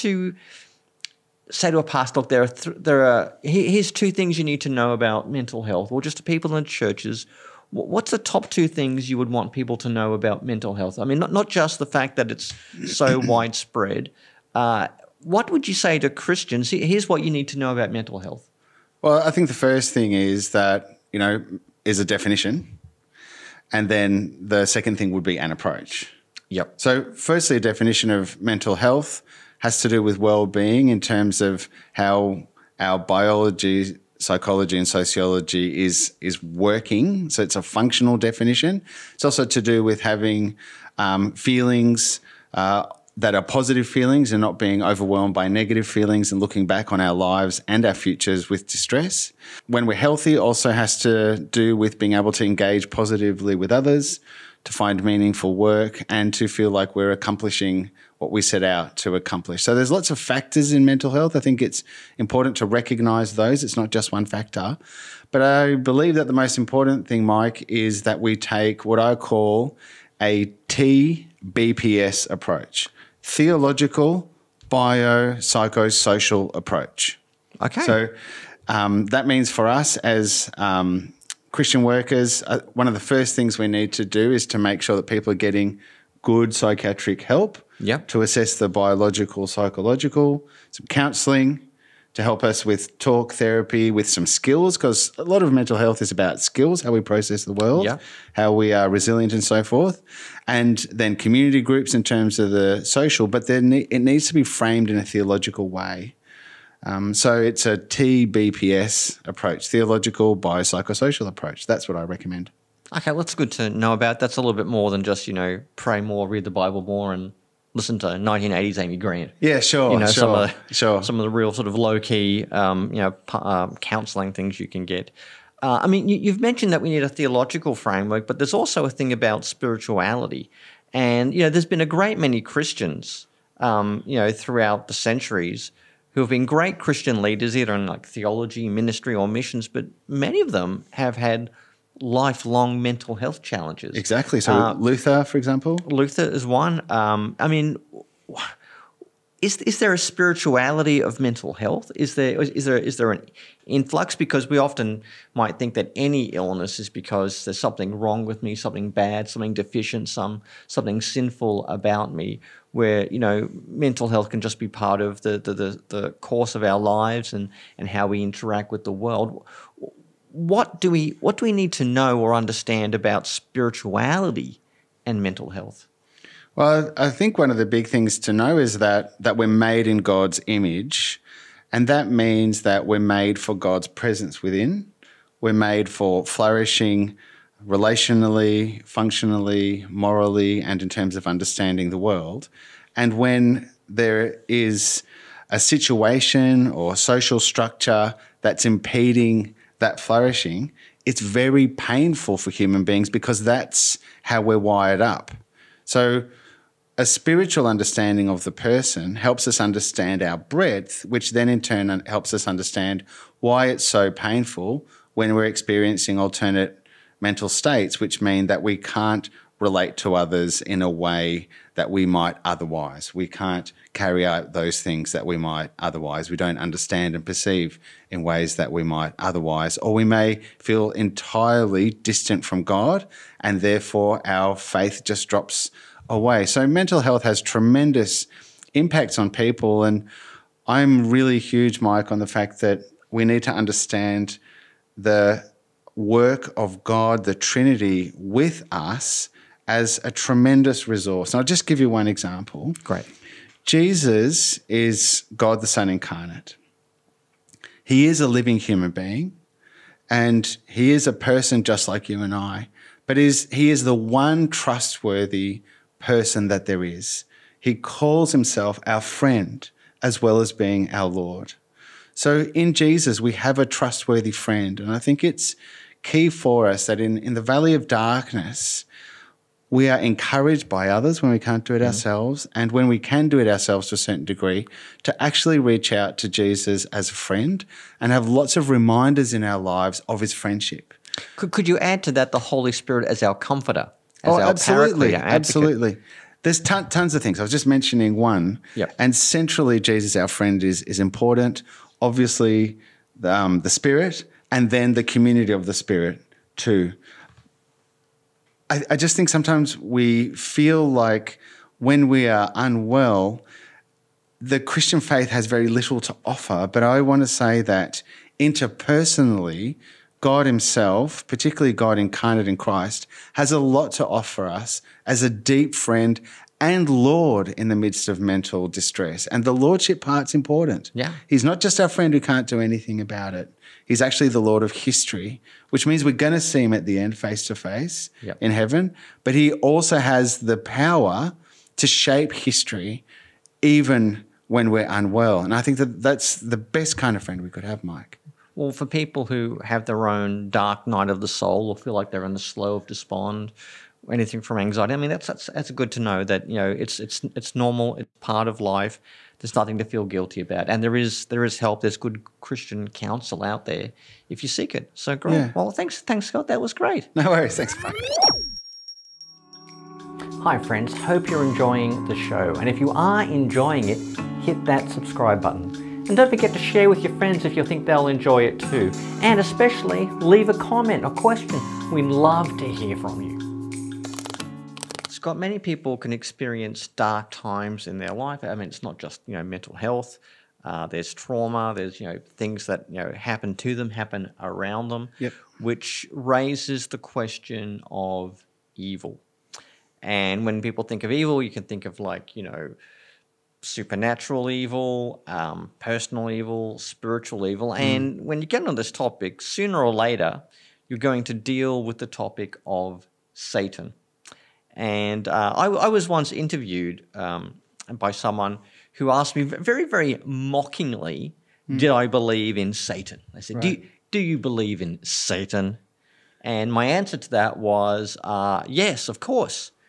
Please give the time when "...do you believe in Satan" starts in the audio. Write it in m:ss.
7:04.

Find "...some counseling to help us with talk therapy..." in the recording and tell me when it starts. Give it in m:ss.
1:30.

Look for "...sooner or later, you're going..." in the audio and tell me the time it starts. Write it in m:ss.
6:49.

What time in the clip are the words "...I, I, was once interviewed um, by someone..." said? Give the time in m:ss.
6:55.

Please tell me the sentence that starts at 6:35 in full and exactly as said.
which raises the question of evil.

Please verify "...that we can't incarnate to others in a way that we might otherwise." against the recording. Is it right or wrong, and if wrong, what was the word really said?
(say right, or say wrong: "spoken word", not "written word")
wrong: "relate", not "incarnate".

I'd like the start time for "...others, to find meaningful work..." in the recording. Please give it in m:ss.
0:53.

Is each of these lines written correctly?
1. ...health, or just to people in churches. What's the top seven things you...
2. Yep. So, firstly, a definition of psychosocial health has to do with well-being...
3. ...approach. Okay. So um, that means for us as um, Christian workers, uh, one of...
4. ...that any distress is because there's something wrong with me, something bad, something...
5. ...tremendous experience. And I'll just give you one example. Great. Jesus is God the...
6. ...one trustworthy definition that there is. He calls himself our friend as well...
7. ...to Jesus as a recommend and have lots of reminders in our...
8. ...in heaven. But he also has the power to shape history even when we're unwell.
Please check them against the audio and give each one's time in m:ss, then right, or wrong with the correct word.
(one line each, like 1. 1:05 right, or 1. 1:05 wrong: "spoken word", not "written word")
1. 0:05 wrong: "two", not "seven"
2. 0:26 wrong: "mental", not "psychosocial"
3. 1:16 right
4. 2:35 wrong: "illness", not "distress"
5. 4:10 wrong: "resource", not "experience"
6. 4:23 wrong: "person", not "definition"
7. 4:46 wrong: "friend", not "recommend"
8. 5:38 right.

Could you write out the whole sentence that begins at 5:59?
There's nothing to feel guilty about.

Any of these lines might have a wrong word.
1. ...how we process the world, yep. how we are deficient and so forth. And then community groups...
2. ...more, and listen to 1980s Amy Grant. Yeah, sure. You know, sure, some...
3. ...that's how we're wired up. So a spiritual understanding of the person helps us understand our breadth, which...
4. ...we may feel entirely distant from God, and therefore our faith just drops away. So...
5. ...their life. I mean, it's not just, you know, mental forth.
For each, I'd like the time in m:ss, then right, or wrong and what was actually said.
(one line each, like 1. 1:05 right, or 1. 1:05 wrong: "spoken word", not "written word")
1. 1:36 wrong: "resilient", not "deficient"
2. 1:56 right
3. 3:23 right
4. 3:49 right
5. 6:27 wrong: "health", not "forth".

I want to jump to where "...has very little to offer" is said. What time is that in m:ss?
5:15.